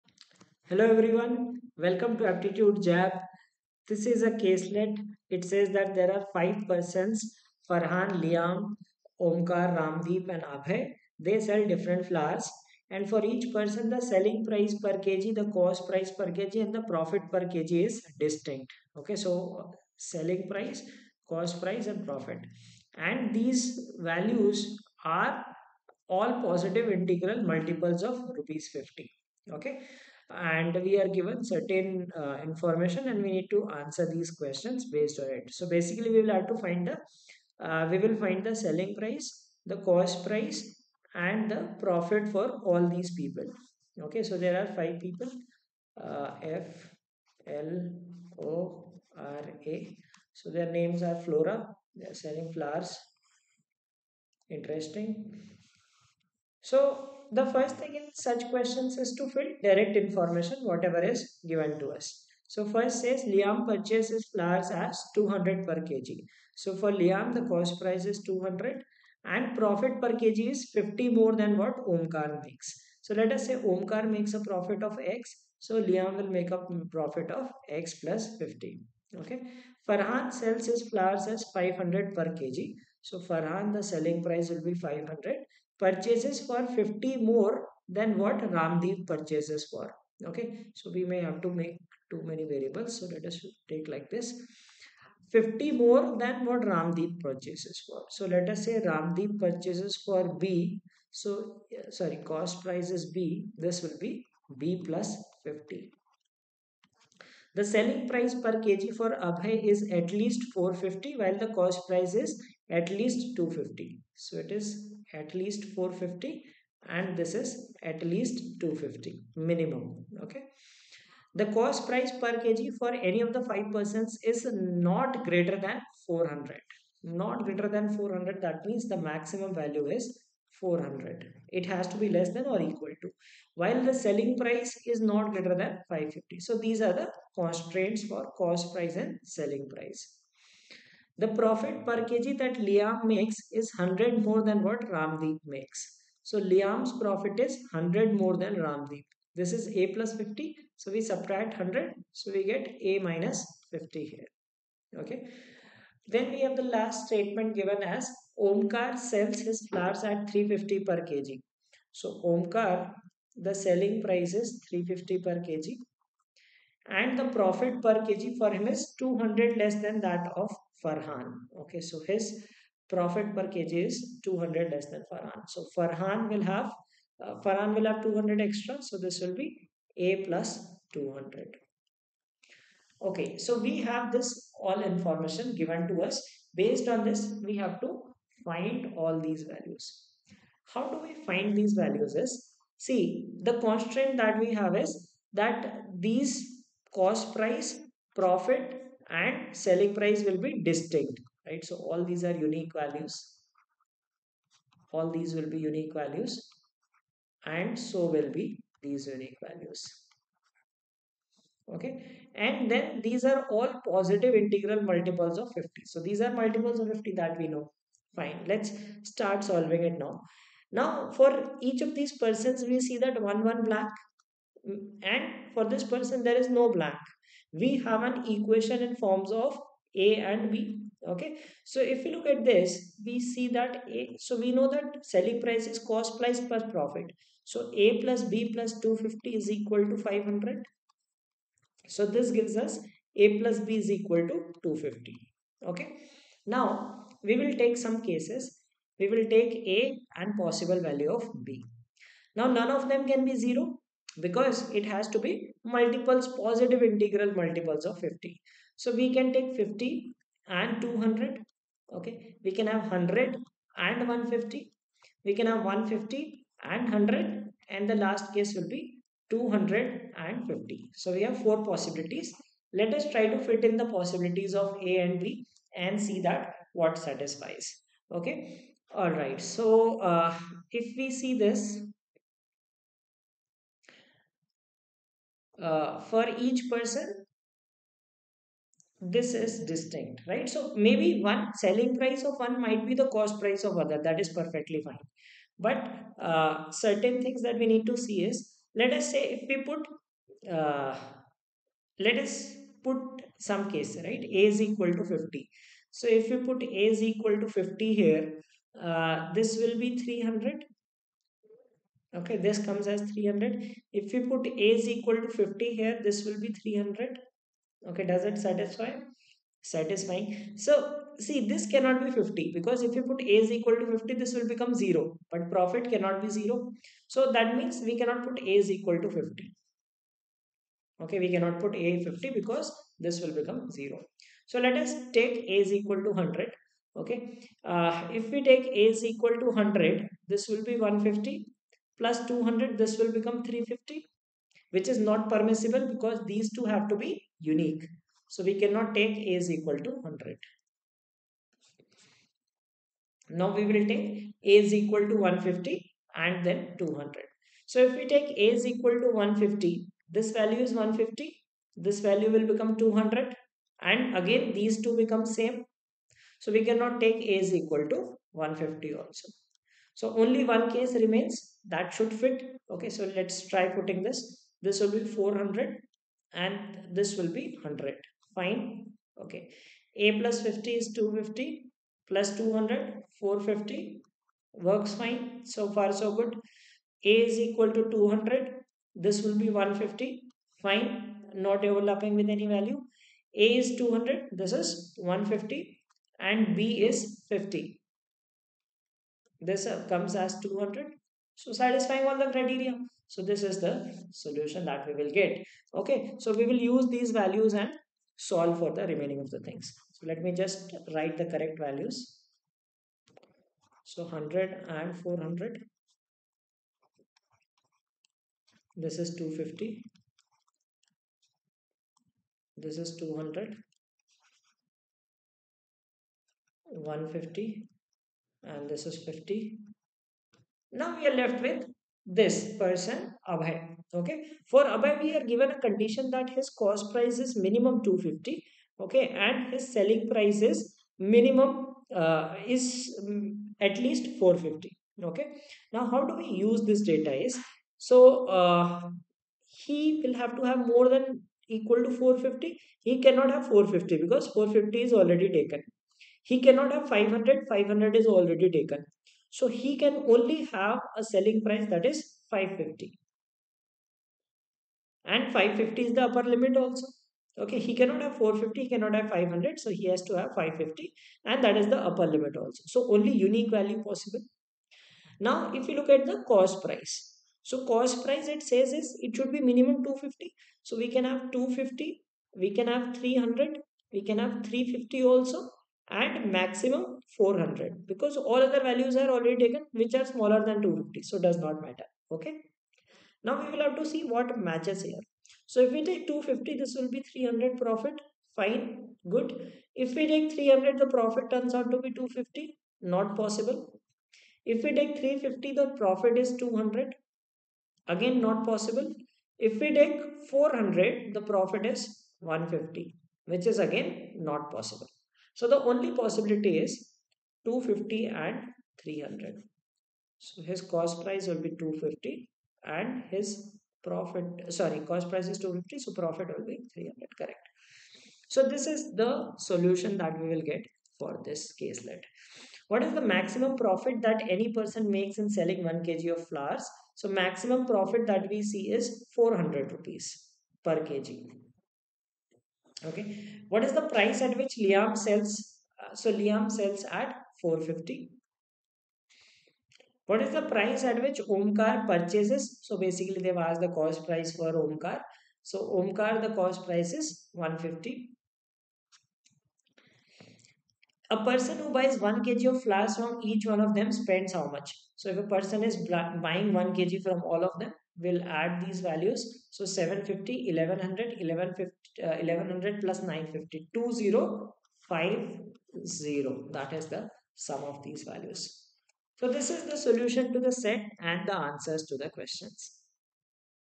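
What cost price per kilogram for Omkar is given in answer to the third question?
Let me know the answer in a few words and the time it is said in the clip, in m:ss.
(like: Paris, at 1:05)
150, at 9:15.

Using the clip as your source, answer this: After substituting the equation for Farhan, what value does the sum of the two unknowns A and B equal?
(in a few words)
250.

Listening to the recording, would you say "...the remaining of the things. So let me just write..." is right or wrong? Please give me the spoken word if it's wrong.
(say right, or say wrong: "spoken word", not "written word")
right.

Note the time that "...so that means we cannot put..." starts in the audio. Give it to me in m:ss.
5:27.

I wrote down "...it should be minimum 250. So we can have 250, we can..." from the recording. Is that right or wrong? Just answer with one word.
right.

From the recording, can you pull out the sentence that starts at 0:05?
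It says that there are five persons, Farhan, Liam, Omkar, Ramdeep and Abhay.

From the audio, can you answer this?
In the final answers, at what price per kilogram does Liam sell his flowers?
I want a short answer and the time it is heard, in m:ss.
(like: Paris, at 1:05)
450, at 9:06.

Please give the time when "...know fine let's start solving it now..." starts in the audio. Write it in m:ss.
3:37.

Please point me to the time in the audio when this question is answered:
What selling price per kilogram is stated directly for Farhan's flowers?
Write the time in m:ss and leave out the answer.
1:19.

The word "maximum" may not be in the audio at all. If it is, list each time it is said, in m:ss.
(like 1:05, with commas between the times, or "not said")
2:09, 8:06, 8:53, 8:57.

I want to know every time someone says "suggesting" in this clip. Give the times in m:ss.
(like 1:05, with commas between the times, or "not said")
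not said.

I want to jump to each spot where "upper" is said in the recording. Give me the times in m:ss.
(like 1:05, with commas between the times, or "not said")
7:46, 7:51.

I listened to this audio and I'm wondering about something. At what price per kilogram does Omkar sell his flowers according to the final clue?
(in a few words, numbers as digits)
350.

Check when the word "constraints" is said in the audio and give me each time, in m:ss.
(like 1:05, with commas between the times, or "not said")
2:17, 3:13.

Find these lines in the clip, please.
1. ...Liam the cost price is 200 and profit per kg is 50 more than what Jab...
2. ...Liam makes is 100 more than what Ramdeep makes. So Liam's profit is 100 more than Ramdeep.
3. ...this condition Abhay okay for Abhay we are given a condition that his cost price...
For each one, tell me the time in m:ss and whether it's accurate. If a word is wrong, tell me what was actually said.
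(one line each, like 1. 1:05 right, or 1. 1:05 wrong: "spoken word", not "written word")
1. 1:06 wrong: "Omkar", not "Jab"
2. 2:22 right
3. 7:12 wrong: "person", not "condition".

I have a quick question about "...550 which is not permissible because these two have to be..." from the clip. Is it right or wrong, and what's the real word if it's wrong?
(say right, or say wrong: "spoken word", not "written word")
wrong: "350", not "550".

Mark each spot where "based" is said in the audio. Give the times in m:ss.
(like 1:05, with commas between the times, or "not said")
0:34, 3:06.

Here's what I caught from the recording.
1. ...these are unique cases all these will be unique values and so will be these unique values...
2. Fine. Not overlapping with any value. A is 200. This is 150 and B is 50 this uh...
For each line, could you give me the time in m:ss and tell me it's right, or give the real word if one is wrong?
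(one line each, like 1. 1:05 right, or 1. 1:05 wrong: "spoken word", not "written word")
1. 3:22 wrong: "values", not "cases"
2. 6:30 right.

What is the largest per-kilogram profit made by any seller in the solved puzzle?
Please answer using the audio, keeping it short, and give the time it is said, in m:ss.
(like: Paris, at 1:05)
400 rupees, at 8:59.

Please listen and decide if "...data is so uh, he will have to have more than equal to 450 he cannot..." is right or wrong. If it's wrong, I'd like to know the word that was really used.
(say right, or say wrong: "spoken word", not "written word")
right.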